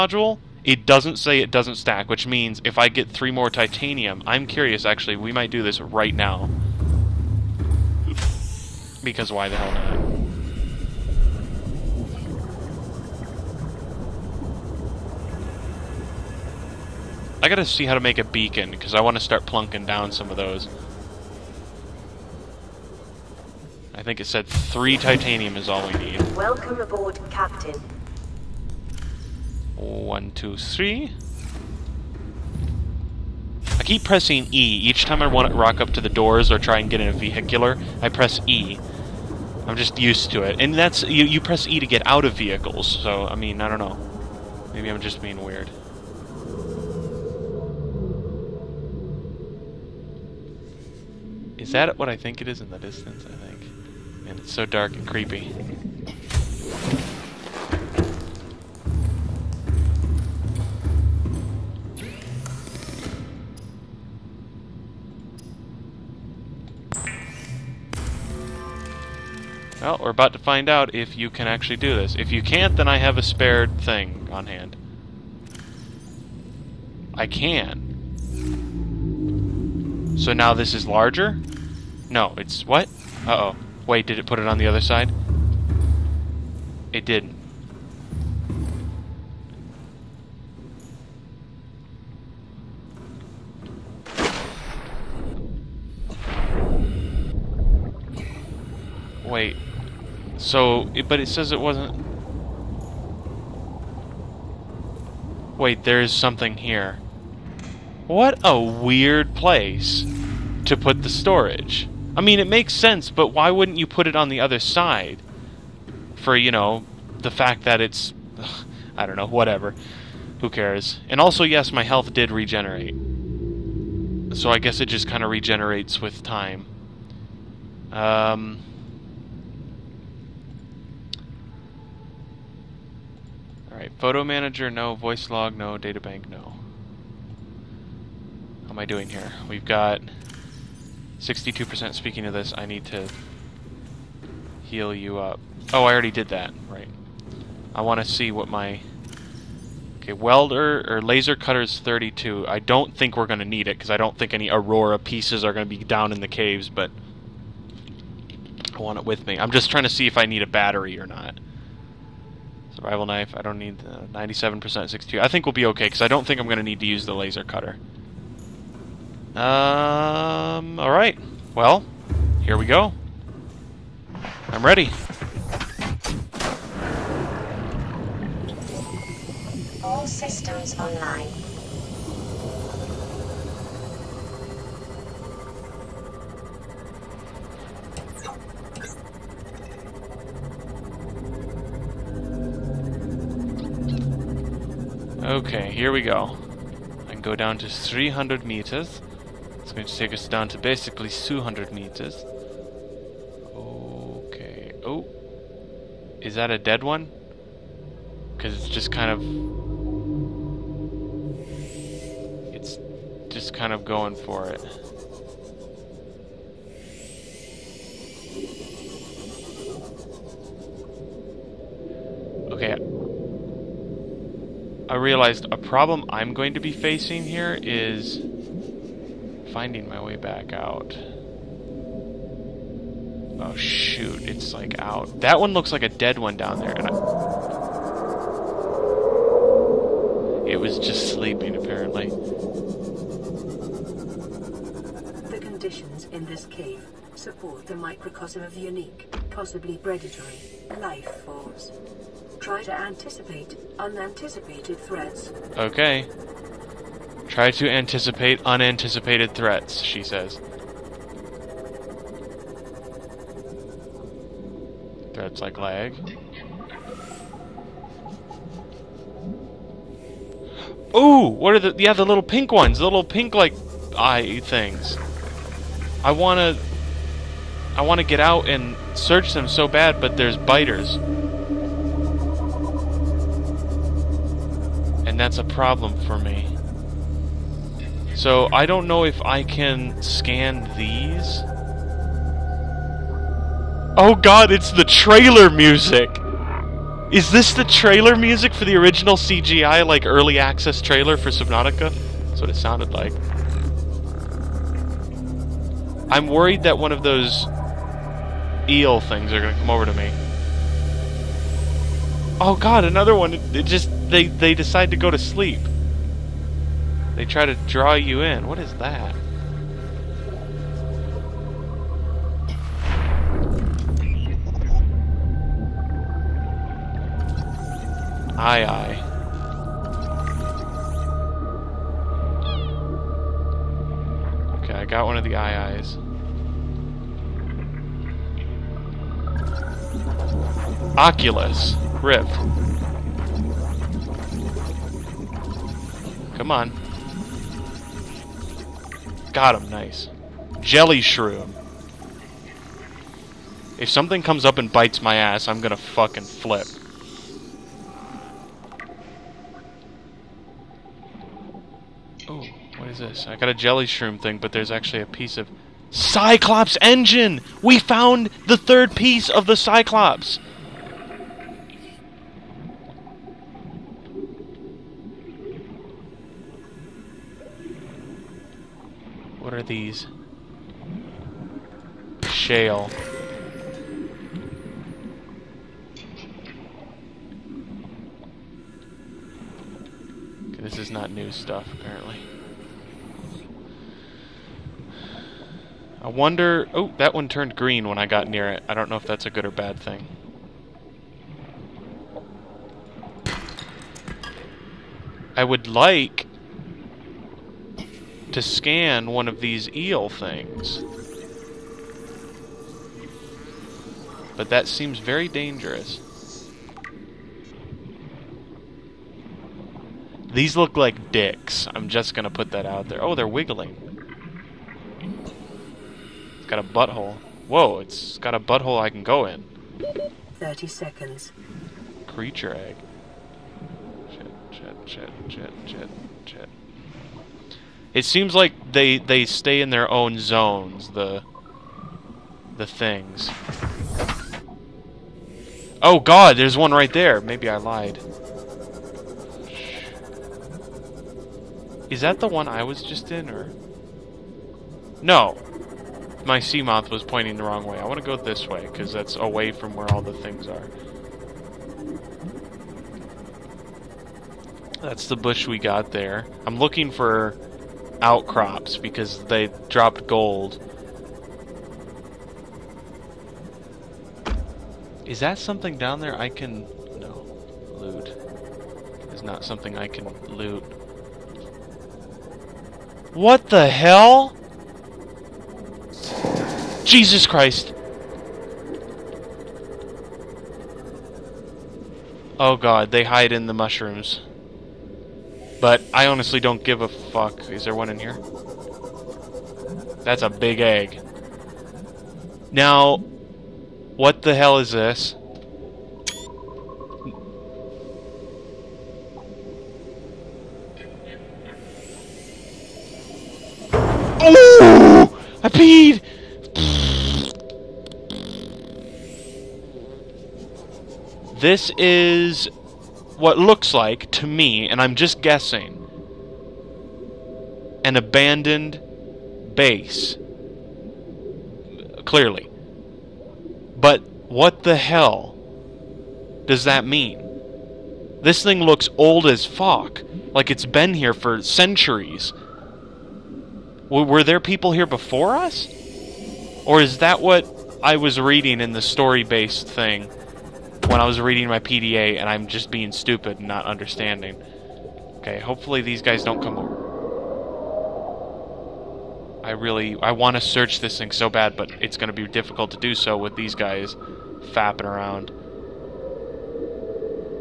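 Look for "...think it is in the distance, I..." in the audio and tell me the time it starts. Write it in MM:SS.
00:52.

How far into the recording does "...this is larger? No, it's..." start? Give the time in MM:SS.
01:20.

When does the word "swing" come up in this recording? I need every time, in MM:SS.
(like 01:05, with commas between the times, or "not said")
not said.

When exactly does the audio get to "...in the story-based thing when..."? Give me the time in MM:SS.
09:08.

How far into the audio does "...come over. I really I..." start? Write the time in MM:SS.
09:16.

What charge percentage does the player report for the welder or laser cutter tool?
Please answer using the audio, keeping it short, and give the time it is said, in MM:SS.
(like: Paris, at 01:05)
32, at 02:31.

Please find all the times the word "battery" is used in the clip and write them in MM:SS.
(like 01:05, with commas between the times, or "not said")
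02:40.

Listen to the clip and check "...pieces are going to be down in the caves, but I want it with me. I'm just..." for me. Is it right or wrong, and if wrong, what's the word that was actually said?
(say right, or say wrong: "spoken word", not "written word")
right.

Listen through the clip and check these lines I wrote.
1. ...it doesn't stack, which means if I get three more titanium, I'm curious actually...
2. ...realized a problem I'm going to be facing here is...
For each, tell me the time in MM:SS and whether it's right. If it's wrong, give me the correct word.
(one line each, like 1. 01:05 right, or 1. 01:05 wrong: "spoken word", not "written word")
1. 00:01 right
2. 03:44 right.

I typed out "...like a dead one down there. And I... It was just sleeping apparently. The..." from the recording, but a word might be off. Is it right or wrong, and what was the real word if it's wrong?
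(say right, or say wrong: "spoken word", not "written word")
right.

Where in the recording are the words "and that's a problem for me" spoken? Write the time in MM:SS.
04:45.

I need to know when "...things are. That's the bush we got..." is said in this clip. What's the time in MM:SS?
07:40.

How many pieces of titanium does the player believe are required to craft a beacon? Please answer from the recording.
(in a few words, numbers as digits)
3.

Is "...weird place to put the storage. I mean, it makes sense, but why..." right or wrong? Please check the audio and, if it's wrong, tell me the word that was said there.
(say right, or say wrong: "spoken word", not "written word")
right.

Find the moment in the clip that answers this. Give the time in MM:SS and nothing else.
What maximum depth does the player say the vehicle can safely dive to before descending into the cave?
03:17.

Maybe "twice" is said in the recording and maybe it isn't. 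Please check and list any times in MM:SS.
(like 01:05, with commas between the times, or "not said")
not said.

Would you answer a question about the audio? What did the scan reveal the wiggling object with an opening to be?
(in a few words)
Creature egg.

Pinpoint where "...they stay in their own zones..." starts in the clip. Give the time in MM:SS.
07:18.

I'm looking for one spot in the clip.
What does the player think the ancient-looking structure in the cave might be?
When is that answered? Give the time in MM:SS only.
08:47.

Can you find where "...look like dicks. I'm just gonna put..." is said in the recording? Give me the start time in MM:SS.
07:00.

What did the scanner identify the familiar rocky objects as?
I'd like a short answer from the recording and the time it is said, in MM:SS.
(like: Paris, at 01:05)
Shale, at 06:22.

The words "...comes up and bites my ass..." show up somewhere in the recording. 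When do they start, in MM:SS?
05:54.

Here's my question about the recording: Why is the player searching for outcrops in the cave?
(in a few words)
gold.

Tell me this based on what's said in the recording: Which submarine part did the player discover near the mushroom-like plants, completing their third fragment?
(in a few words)
Cyclops engine.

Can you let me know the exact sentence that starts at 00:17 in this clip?
I gotta see how to make a beacon, because I want to start plunking down some of those.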